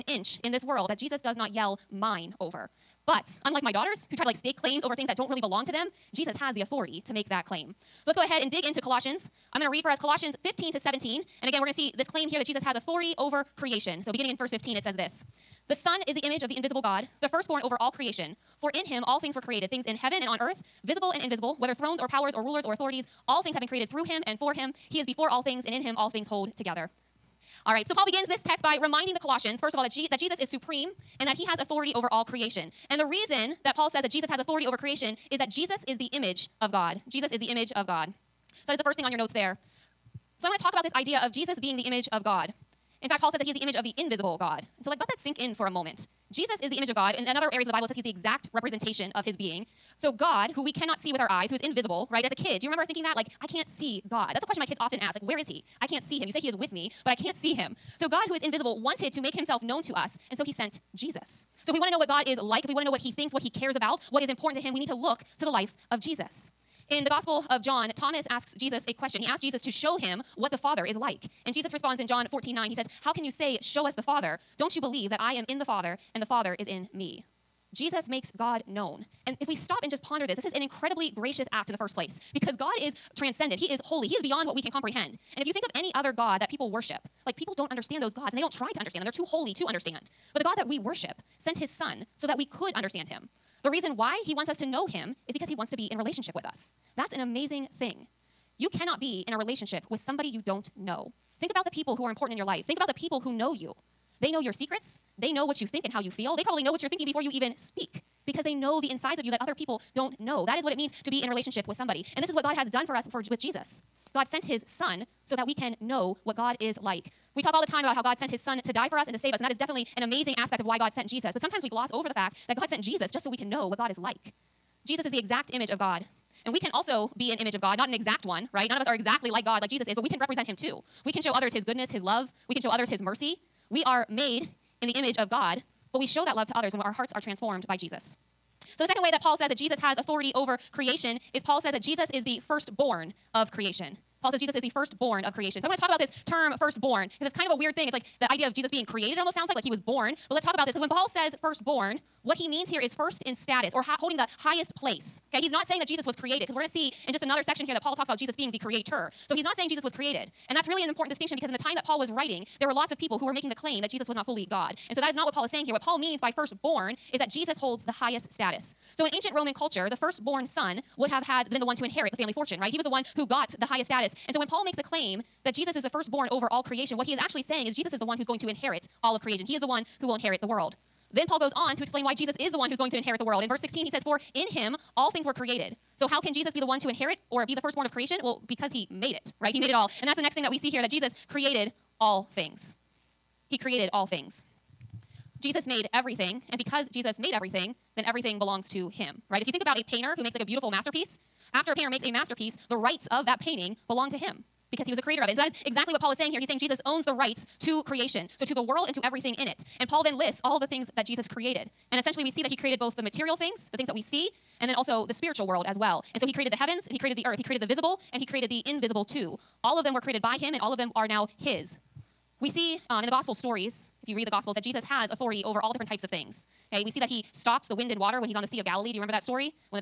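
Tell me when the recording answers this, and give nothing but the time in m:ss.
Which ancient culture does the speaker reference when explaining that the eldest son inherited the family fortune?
2:49.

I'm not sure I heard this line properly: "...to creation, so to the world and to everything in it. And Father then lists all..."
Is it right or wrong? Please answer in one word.
wrong.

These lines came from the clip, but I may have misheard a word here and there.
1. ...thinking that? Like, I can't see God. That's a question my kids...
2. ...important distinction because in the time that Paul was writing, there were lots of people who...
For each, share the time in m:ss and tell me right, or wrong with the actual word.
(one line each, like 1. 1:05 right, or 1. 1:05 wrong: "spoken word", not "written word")
1. 0:52 right
2. 2:40 right.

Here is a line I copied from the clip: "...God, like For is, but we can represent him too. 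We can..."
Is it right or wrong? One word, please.
wrong.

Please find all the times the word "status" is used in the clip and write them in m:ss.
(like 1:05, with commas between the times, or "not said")
2:33, 2:48, 2:53.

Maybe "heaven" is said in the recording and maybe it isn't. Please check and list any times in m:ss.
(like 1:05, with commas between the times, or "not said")
0:19, 3:36.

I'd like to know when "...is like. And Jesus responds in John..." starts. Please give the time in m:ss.
1:10.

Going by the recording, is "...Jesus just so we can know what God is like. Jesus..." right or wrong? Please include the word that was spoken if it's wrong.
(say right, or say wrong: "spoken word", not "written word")
right.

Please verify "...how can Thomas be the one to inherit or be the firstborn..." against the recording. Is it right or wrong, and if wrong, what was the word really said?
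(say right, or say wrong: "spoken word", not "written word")
wrong: "Jesus", not "Thomas".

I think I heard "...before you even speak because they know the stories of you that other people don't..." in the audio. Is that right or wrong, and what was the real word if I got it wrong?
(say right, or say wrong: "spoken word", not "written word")
wrong: "insides", not "stories".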